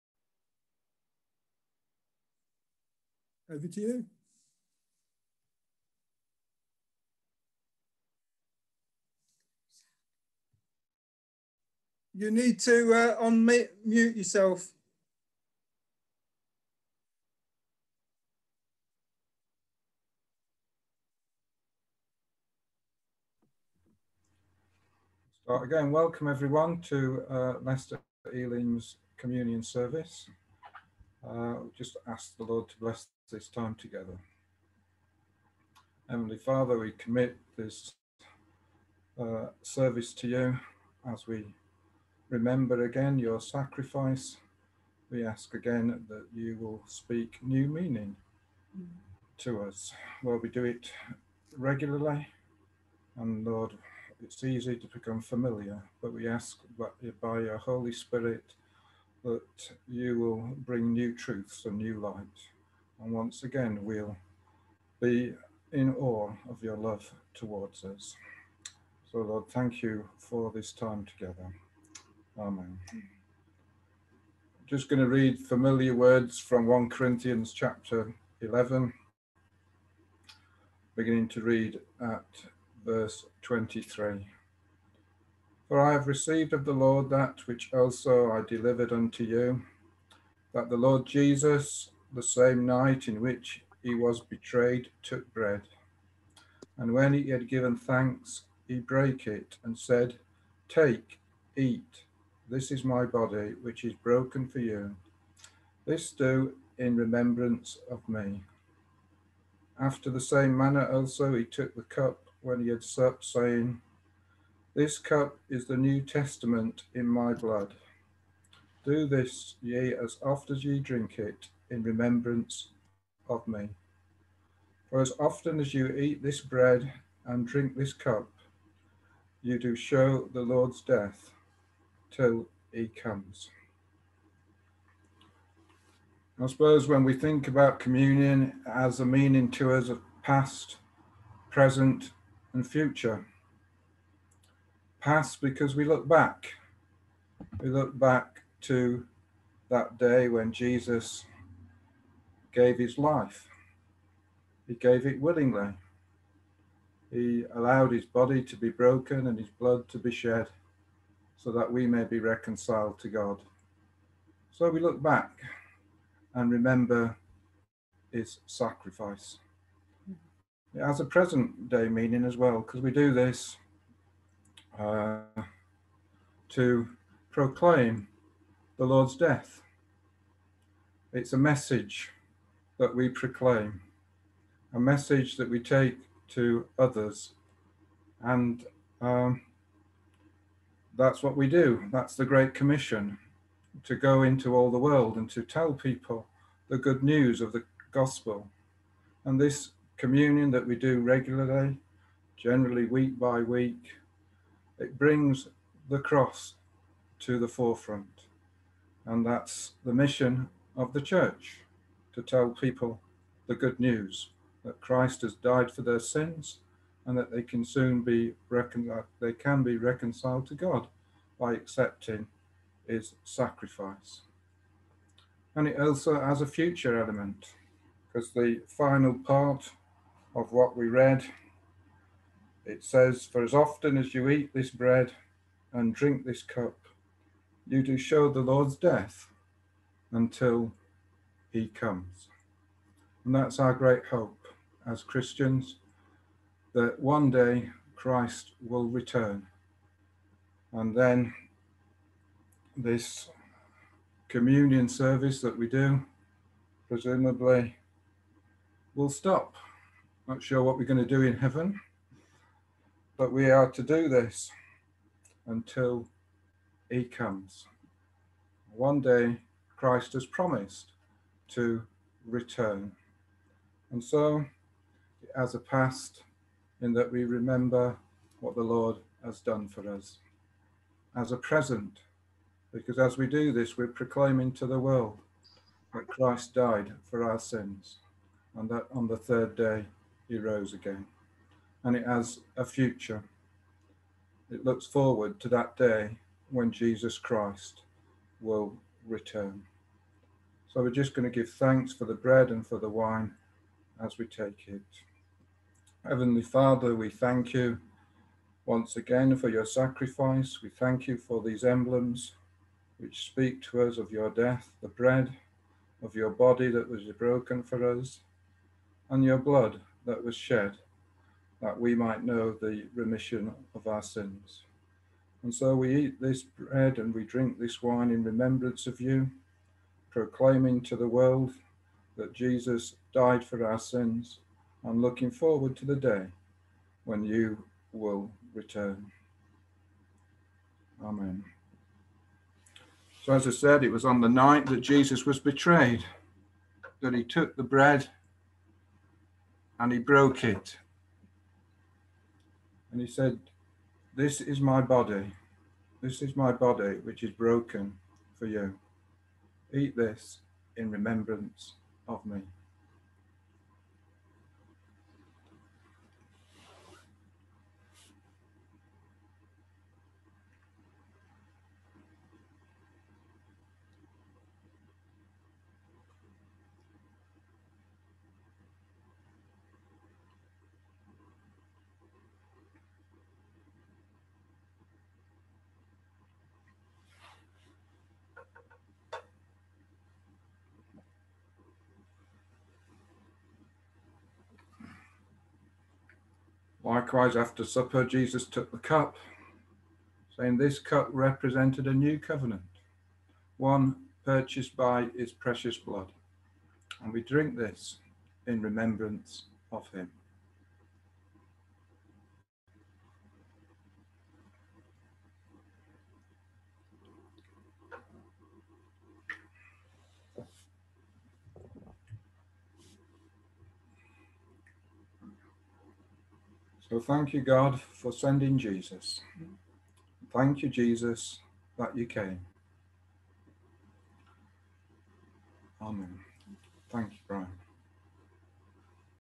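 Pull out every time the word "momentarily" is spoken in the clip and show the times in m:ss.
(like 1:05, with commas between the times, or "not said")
not said.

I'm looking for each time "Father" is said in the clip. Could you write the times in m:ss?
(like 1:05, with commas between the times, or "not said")
0:36, 5:06.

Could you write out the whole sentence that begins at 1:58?
Do this, ye, as oft as ye drink it, in remembrance of me.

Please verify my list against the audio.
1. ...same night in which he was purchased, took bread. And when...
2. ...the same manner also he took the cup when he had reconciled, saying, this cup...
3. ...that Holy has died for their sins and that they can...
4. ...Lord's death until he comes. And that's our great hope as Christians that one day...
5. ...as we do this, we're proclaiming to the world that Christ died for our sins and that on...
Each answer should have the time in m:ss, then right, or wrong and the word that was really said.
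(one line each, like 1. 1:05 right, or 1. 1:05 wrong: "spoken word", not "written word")
1. 1:32 wrong: "betrayed", not "purchased"
2. 1:50 wrong: "supped", not "reconciled"
3. 3:34 wrong: "Christ", not "Holy"
4. 3:58 right
5. 4:42 right.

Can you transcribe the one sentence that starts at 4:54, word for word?
It looks forward to that day when Jesus Christ will return.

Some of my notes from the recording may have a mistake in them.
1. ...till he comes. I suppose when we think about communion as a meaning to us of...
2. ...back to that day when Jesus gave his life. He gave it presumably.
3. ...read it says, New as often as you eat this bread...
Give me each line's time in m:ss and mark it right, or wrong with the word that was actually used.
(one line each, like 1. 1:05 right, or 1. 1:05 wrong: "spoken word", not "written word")
1. 2:12 right
2. 2:27 wrong: "willingly", not "presumably"
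3. 3:50 wrong: "For", not "New".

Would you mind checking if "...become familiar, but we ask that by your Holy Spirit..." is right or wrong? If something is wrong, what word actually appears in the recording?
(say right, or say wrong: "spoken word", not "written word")
right.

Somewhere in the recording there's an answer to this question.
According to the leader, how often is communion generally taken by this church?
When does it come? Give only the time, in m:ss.
3:22.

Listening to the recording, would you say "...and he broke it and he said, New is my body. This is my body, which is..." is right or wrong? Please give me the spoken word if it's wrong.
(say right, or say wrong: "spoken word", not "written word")
wrong: "This", not "New".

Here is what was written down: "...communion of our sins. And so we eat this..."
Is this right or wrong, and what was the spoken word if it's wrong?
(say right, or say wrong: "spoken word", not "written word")
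wrong: "remission", not "communion".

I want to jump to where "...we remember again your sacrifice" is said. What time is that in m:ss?
0:41.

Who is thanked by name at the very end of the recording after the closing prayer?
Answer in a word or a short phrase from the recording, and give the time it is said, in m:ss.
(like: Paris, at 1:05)
Brian, at 7:17.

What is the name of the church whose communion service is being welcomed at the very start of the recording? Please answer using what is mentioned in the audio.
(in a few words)
Leicester Elim.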